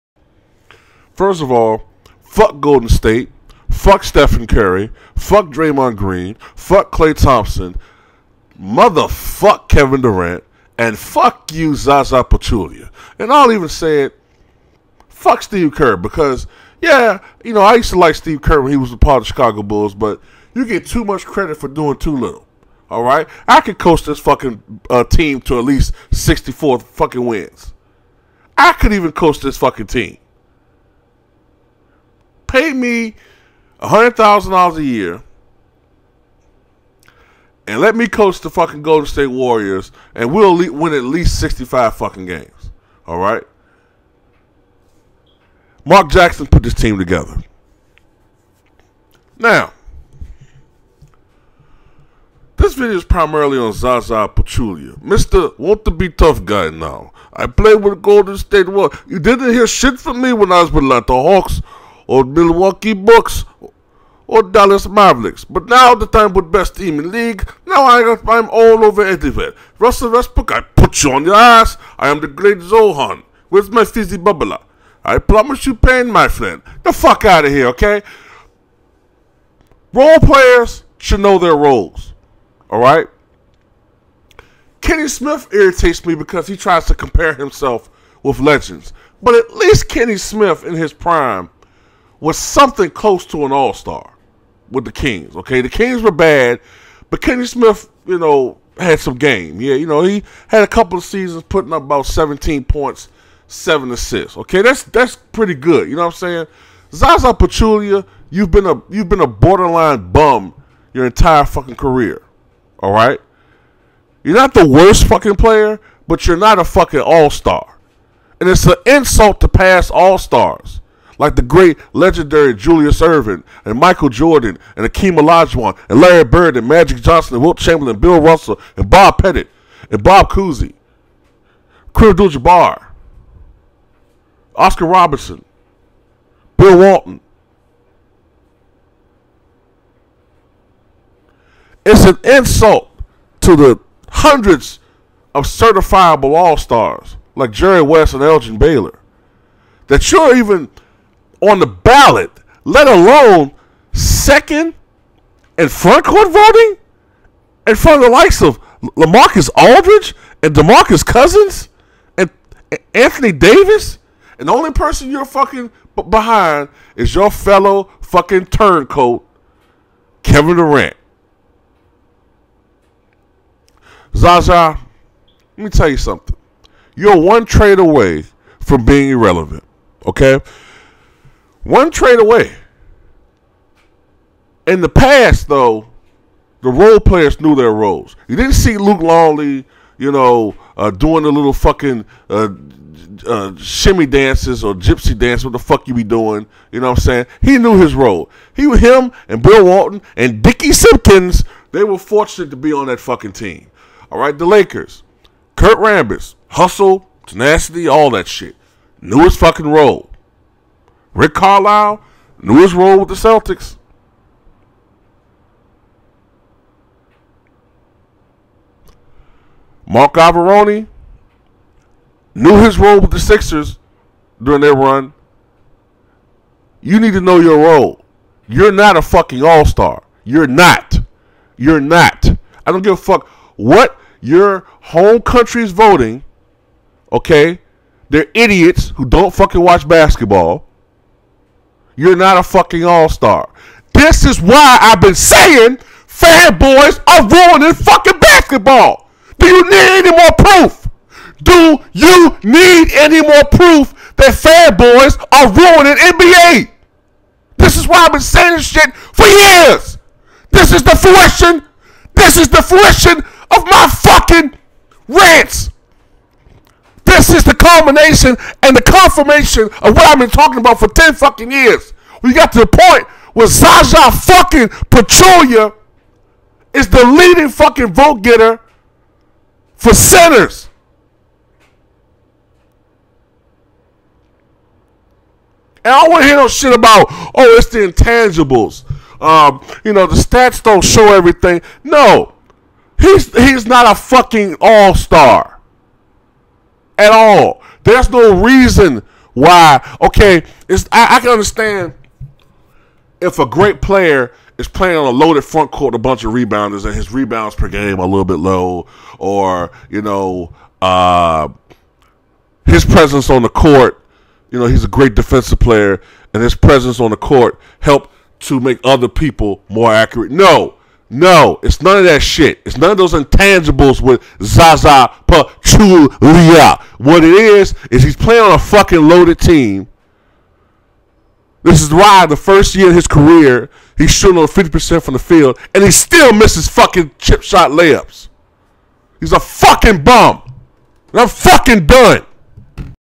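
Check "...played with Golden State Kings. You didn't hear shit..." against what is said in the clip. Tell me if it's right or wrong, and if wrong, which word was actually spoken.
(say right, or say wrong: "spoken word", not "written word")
wrong: "Warriors", not "Kings".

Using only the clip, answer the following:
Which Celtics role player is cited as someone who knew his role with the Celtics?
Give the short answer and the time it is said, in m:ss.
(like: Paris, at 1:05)
Rick Carlisle, at 3:31.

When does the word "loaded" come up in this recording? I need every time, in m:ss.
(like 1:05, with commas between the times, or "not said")
5:05, 5:29.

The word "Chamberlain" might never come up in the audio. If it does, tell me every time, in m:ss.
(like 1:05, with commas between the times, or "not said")
2:07.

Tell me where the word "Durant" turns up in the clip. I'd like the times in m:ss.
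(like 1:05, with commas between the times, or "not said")
0:10, 2:50.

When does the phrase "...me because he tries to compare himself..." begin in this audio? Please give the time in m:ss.
1:26.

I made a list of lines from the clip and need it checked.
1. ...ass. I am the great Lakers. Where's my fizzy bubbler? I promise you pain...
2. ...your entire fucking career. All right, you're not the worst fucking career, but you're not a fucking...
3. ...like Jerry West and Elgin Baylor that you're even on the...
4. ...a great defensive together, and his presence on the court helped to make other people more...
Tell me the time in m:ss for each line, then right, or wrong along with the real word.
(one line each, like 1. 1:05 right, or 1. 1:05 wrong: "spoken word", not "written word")
1. 1:11 wrong: "Zohan", not "Lakers"
2. 1:50 wrong: "player", not "career"
3. 2:27 right
4. 5:14 wrong: "player", not "together".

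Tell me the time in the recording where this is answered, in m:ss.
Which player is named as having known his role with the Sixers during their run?
3:39.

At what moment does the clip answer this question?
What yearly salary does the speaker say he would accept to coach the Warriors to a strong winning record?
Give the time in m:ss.
0:33.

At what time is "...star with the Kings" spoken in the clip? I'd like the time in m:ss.
1:33.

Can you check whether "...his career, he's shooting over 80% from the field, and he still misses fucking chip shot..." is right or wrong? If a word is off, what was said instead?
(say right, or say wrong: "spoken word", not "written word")
wrong: "50", not "80".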